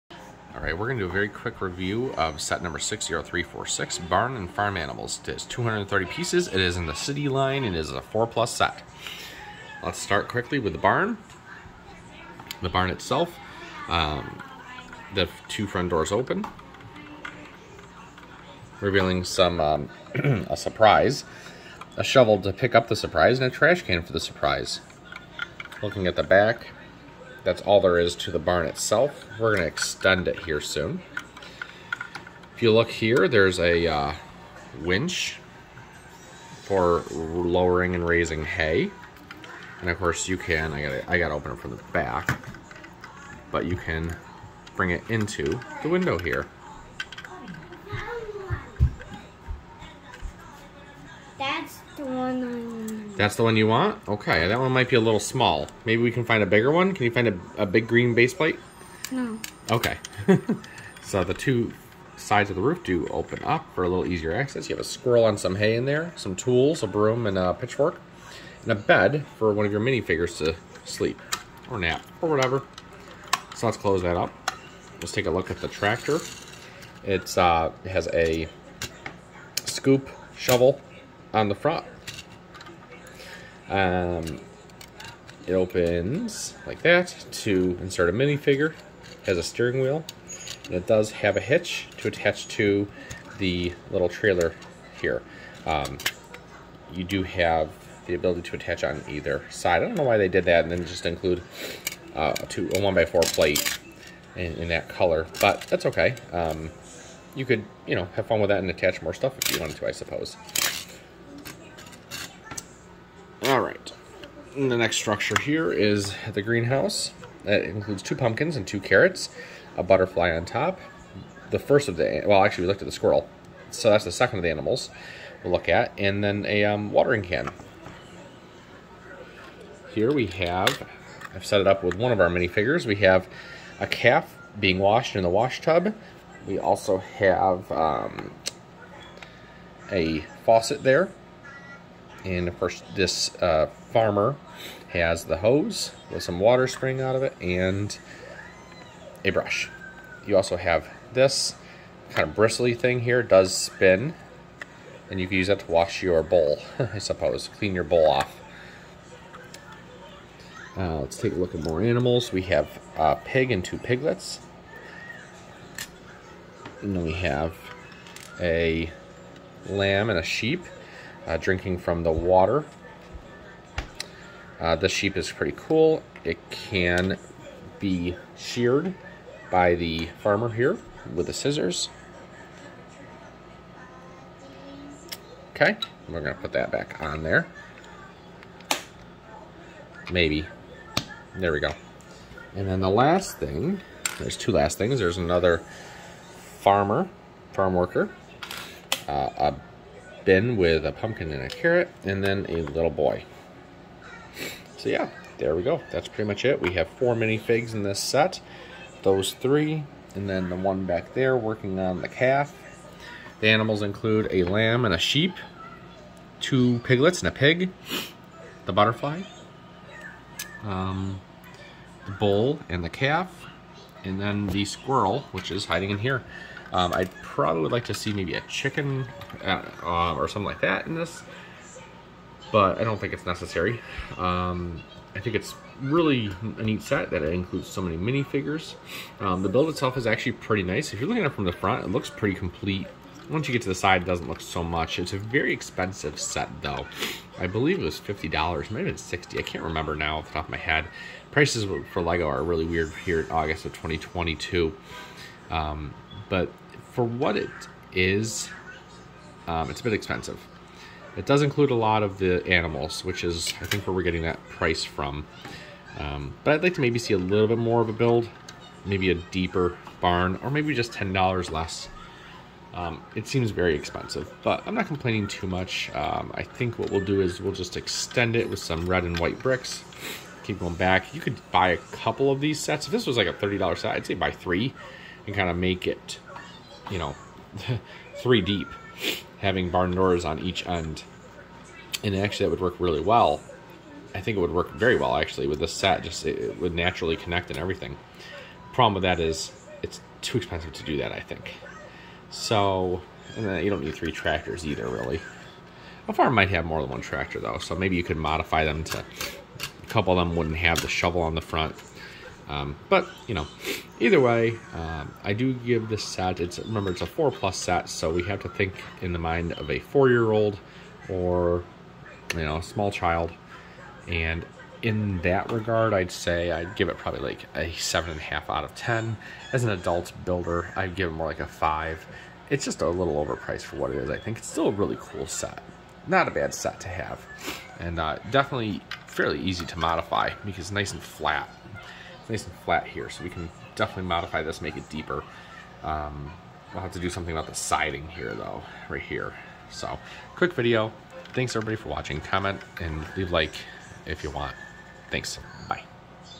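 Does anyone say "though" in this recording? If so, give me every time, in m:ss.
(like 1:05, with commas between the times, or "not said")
4:06, 5:07, 5:48.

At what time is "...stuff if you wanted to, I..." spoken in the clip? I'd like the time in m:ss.
1:49.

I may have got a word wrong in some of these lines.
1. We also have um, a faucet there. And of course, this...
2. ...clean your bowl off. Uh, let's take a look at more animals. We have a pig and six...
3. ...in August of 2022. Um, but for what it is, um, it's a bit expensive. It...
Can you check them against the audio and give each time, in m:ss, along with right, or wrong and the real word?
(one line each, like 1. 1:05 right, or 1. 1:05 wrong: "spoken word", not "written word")
1. 2:16 right
2. 2:37 wrong: "two", not "six"
3. 4:13 right.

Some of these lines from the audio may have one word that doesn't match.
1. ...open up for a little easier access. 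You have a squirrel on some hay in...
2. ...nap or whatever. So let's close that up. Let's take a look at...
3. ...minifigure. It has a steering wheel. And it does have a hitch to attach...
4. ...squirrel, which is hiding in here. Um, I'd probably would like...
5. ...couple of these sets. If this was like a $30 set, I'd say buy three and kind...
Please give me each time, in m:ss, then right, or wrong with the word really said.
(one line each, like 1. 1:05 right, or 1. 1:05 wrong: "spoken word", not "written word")
1. 1:03 right
2. 1:11 right
3. 1:28 right
4. 3:44 right
5. 4:41 right.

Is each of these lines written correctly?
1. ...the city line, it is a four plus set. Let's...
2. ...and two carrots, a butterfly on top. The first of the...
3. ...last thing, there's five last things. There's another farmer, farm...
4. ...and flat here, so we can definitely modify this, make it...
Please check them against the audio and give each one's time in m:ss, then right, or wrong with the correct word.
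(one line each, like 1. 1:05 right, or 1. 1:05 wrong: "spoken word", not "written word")
1. 0:06 right
2. 1:58 right
3. 3:12 wrong: "two", not "five"
4. 5:42 right.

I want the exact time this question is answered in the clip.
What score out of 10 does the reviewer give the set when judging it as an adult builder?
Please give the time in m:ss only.
5:31.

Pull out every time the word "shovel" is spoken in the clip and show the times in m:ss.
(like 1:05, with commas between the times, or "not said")
0:22, 1:20, 5:10.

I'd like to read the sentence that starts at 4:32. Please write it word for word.
Um, it seems very expensive, but I'm not complaining too much.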